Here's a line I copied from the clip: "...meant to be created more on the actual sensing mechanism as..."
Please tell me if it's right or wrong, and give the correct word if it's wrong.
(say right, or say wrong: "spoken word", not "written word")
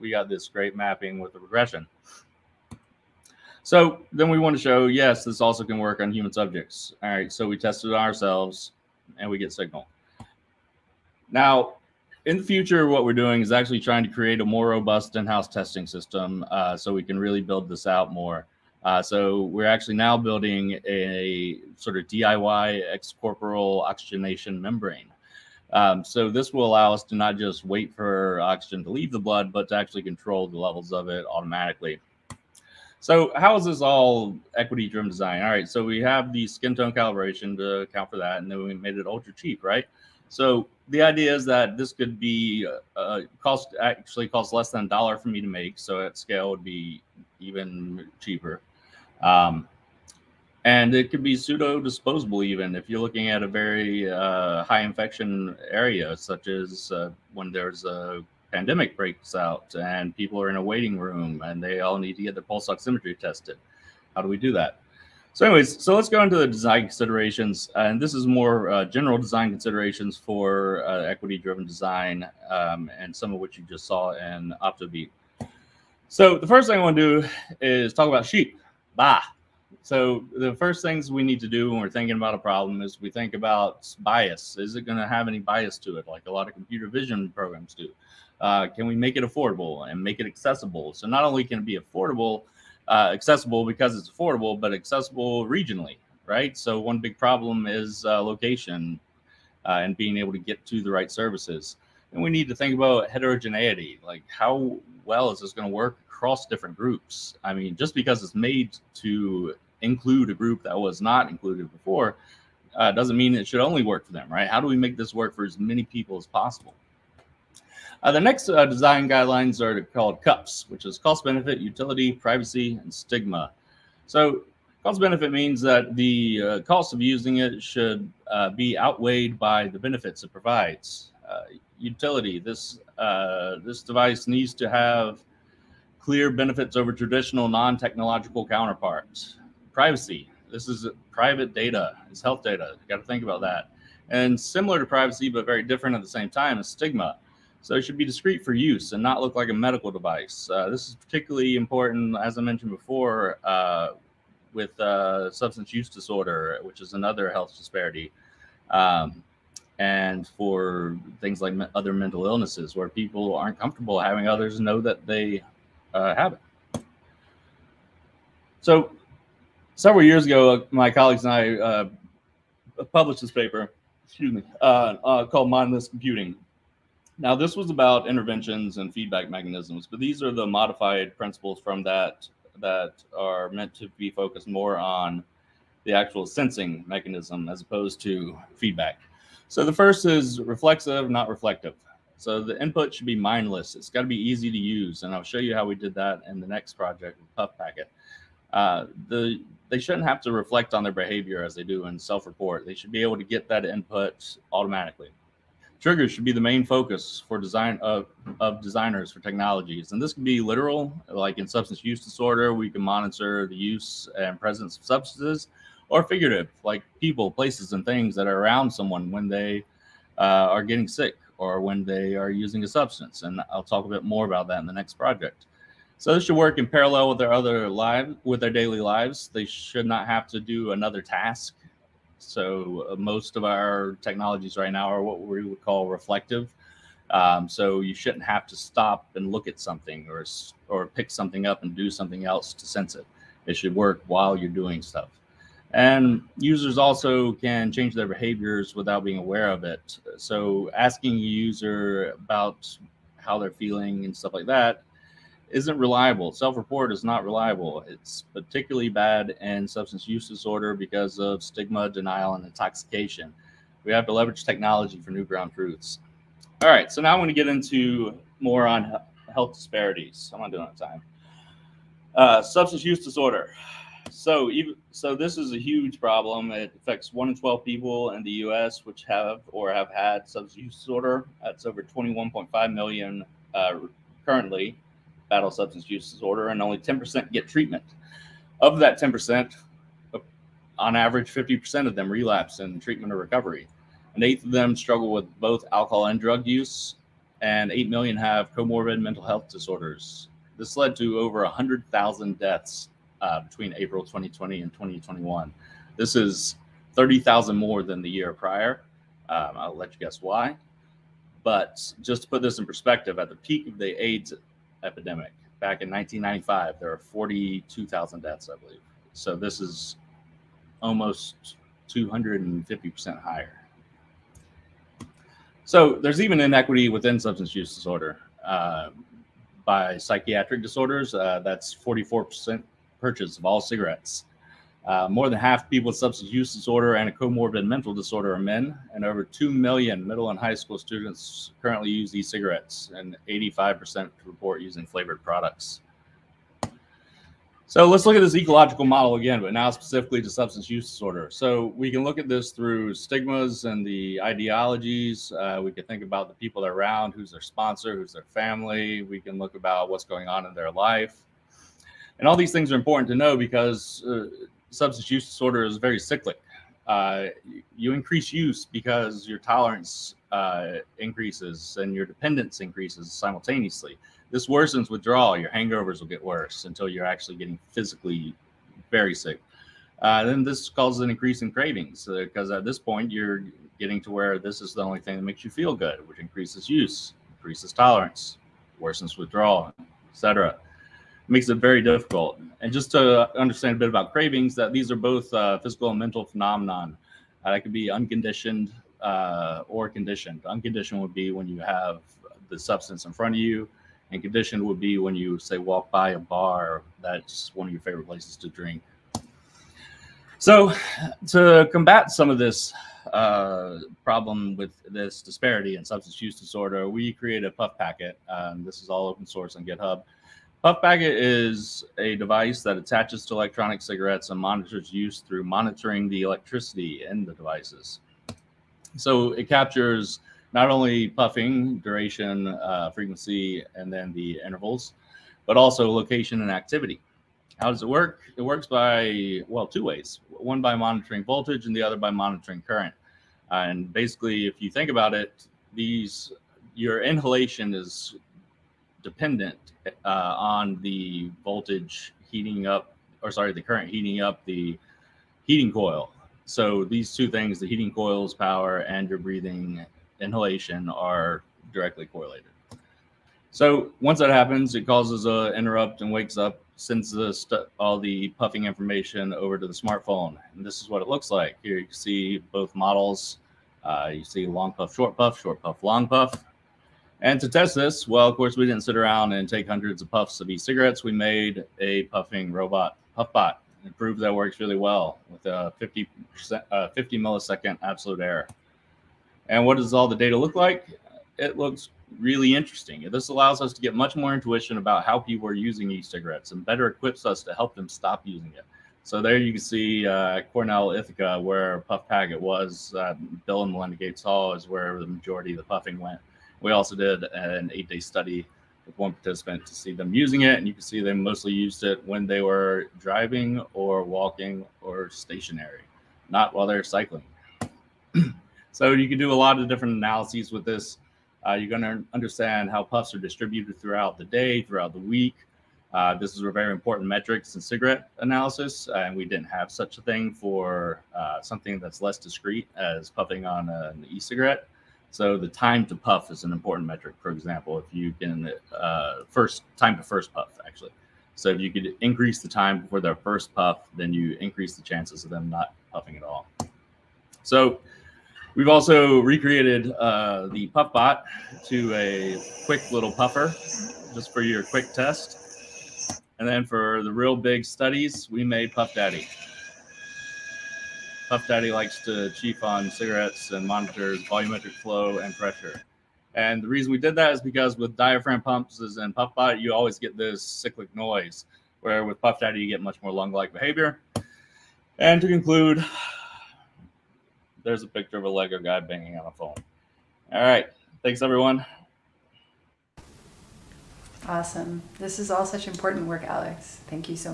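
wrong: "focused", not "created".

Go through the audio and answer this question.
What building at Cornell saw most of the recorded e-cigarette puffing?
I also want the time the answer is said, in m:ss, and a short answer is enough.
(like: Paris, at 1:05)
Bill and Melinda Gates Hall, at 8:23.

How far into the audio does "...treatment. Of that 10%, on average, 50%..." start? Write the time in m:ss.
4:47.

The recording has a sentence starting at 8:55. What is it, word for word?
So the time to puff is an important metric.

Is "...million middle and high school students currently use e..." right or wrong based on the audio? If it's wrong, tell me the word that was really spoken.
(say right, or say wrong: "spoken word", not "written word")
right.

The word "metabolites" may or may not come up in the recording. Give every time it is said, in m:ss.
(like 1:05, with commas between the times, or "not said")
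not said.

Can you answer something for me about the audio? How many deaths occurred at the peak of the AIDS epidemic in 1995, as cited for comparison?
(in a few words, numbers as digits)
42,000.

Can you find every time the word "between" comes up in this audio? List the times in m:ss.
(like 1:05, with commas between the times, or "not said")
5:03.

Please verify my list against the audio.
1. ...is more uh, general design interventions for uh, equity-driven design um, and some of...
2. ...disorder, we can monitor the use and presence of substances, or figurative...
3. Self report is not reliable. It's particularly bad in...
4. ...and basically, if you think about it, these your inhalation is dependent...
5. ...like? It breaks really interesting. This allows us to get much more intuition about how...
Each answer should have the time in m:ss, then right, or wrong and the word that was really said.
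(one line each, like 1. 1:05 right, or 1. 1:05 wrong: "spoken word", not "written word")
1. 1:08 wrong: "considerations", not "interventions"
2. 3:32 right
3. 4:16 right
4. 7:23 right
5. 8:10 wrong: "looks", not "breaks".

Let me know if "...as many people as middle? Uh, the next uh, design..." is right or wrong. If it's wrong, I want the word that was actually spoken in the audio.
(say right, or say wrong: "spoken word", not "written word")
wrong: "possible", not "middle".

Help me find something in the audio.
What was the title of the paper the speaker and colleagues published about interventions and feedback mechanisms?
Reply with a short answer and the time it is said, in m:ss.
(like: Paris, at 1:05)
Mindless Computing, at 2:55.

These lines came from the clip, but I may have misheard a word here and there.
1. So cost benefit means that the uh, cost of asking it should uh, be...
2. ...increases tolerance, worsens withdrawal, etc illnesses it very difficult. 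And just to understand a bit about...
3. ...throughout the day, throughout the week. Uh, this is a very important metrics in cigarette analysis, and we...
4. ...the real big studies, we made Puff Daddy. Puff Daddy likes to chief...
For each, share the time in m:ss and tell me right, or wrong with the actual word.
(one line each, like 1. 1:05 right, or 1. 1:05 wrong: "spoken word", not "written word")
1. 2:04 wrong: "using", not "asking"
2. 6:27 wrong: "makes", not "illnesses"
3. 8:43 right
4. 9:17 right.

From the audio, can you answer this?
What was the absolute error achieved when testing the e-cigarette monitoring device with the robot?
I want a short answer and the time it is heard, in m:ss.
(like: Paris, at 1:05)
50 milliseconds, at 8:06.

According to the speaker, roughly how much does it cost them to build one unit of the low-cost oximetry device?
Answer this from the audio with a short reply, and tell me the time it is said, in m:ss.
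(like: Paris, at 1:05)
less than a dollar, at 0:44.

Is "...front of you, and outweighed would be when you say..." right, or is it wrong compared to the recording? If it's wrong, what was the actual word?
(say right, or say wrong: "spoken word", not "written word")
wrong: "conditioned", not "outweighed".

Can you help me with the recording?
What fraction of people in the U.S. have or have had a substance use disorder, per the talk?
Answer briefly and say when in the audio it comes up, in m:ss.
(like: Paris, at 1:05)
1 in 12, at 4:37.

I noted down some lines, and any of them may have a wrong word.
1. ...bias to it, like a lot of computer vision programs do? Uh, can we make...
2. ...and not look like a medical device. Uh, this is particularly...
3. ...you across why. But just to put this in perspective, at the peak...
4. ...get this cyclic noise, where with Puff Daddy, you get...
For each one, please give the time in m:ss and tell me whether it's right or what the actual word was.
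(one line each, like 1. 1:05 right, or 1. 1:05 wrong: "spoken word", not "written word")
1. 1:25 right
2. 2:28 right
3. 5:09 wrong: "guess", not "across"
4. 9:29 right.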